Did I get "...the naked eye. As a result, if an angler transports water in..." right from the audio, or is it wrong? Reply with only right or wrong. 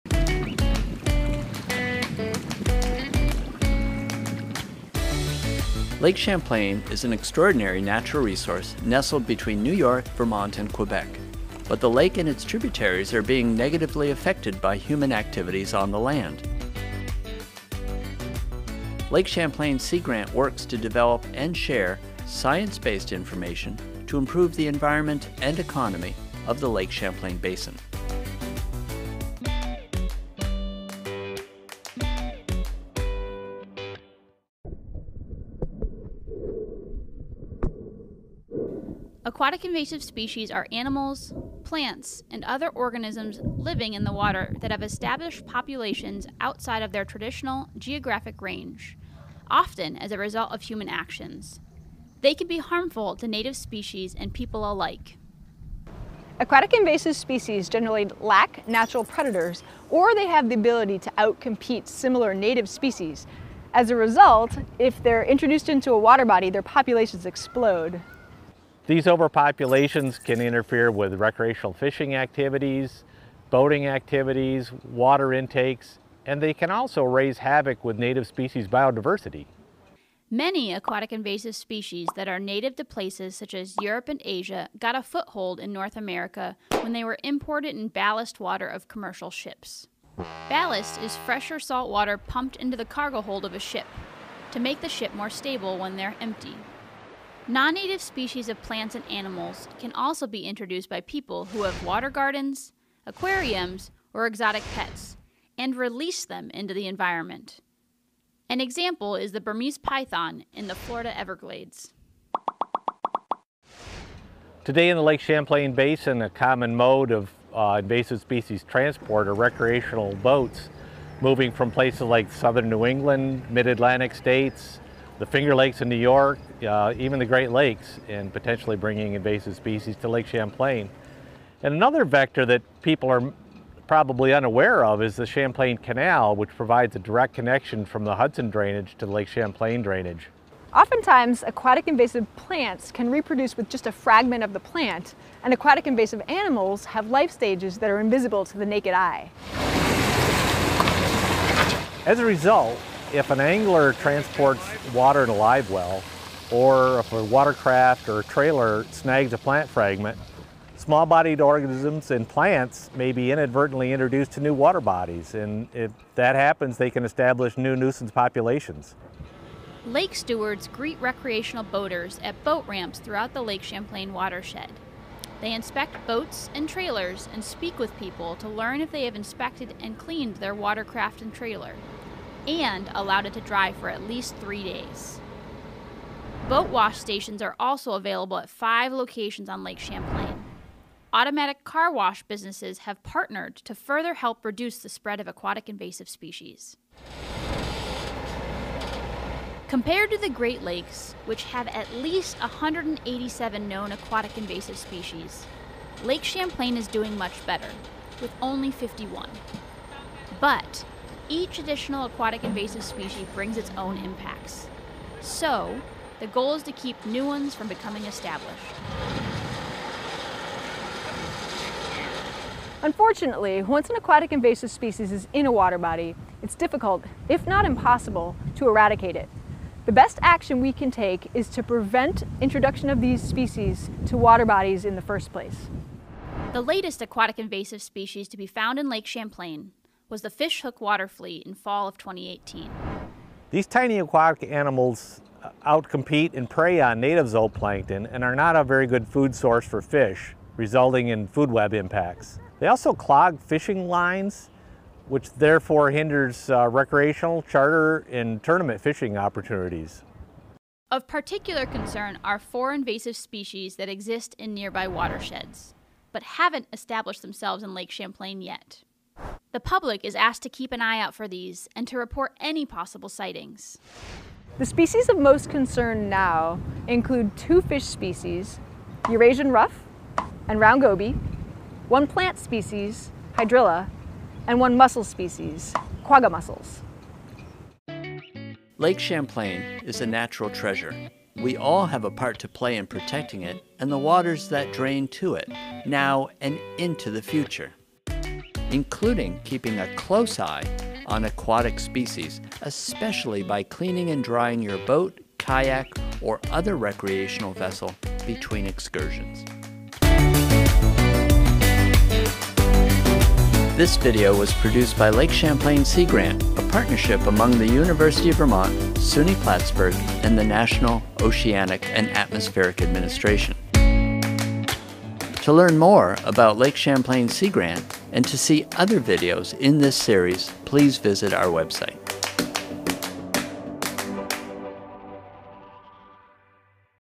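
right.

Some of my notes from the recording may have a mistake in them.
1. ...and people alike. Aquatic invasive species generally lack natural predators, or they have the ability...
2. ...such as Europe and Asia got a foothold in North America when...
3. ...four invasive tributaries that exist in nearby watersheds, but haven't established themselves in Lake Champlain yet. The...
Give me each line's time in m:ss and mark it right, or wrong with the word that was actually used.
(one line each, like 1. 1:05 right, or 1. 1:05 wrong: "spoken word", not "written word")
1. 0:54 right
2. 1:23 right
3. 4:22 wrong: "species", not "tributaries".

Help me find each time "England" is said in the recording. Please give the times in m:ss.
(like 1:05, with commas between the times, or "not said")
2:02.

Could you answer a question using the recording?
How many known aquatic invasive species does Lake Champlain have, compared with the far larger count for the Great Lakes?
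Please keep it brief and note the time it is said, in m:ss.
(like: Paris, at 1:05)
51, at 3:28.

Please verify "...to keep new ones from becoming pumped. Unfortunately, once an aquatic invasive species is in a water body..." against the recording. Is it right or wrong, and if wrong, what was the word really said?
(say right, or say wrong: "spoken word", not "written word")
wrong: "established", not "pumped".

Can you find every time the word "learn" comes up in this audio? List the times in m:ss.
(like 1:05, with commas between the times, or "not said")
2:58, 5:25.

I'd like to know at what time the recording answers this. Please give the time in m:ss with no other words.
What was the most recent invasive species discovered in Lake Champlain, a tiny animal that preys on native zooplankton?
4:00.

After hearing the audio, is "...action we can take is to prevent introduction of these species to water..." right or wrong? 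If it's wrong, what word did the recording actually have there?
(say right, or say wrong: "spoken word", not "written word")
right.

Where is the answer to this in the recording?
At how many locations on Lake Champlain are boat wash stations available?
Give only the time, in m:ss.
3:08.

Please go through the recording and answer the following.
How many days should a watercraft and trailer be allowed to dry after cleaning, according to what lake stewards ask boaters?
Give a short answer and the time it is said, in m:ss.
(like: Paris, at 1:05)
3, at 3:04.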